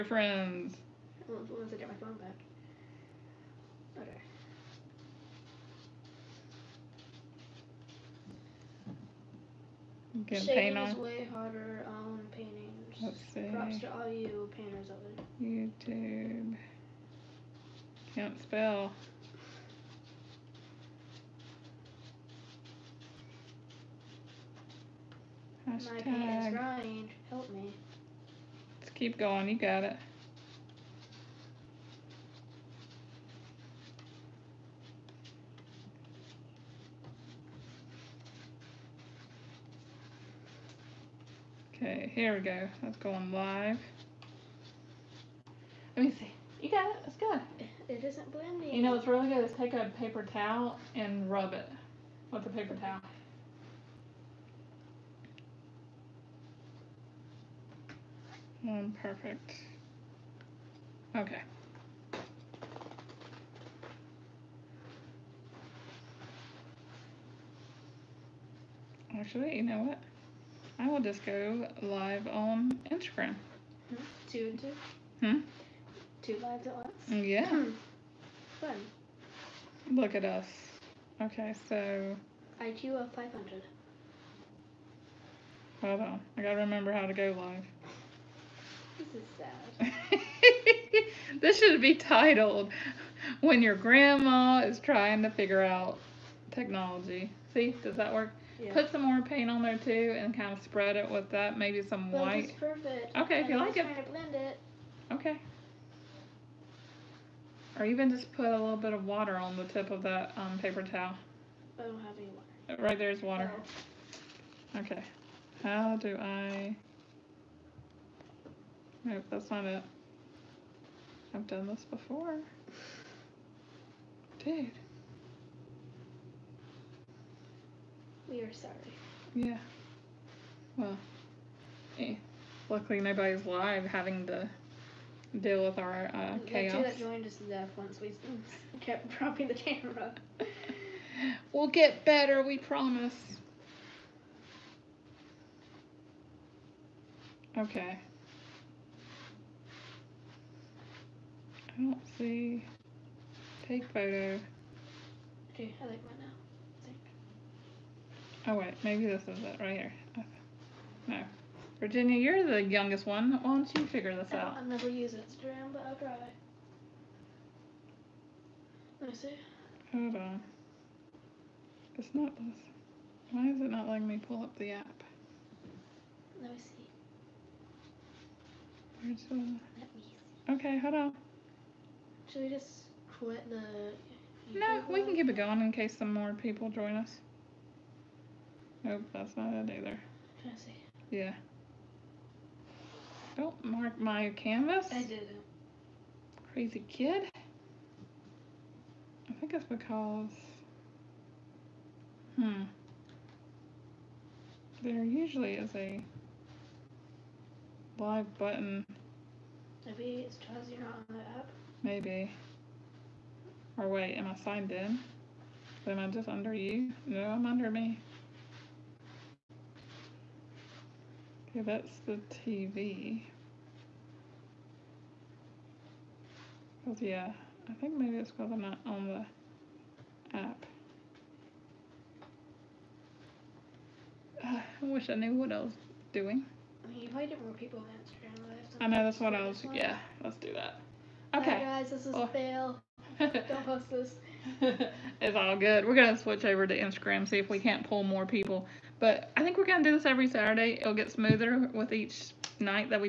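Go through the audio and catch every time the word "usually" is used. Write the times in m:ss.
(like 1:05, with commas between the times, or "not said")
3:25.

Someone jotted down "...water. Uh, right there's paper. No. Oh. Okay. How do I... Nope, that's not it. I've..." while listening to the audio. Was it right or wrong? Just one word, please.
wrong.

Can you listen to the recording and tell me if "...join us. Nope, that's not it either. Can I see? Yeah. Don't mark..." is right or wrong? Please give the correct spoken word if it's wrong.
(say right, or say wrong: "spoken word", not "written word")
right.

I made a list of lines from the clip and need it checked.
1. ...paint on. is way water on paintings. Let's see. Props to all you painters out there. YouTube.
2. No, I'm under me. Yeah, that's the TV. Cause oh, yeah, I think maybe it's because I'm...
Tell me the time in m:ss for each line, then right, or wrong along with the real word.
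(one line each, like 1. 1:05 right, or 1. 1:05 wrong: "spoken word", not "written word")
1. 0:10 wrong: "harder", not "water"
2. 3:37 right.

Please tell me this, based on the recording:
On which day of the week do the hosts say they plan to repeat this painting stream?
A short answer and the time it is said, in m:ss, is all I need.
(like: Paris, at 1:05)
Saturday, at 4:10.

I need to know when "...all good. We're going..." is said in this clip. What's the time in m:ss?
4:05.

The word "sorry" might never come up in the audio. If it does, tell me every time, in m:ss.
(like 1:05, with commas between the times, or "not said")
2:08.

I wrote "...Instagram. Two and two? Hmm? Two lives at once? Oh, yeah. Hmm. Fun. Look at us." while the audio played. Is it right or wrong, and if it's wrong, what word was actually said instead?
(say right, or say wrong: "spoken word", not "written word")
right.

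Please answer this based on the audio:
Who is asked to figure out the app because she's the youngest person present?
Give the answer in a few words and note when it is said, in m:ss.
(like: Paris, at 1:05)
Virginia, at 2:41.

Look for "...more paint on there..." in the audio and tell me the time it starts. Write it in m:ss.
1:39.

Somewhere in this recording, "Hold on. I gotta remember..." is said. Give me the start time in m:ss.
1:25.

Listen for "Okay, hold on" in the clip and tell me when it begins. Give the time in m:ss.
3:00.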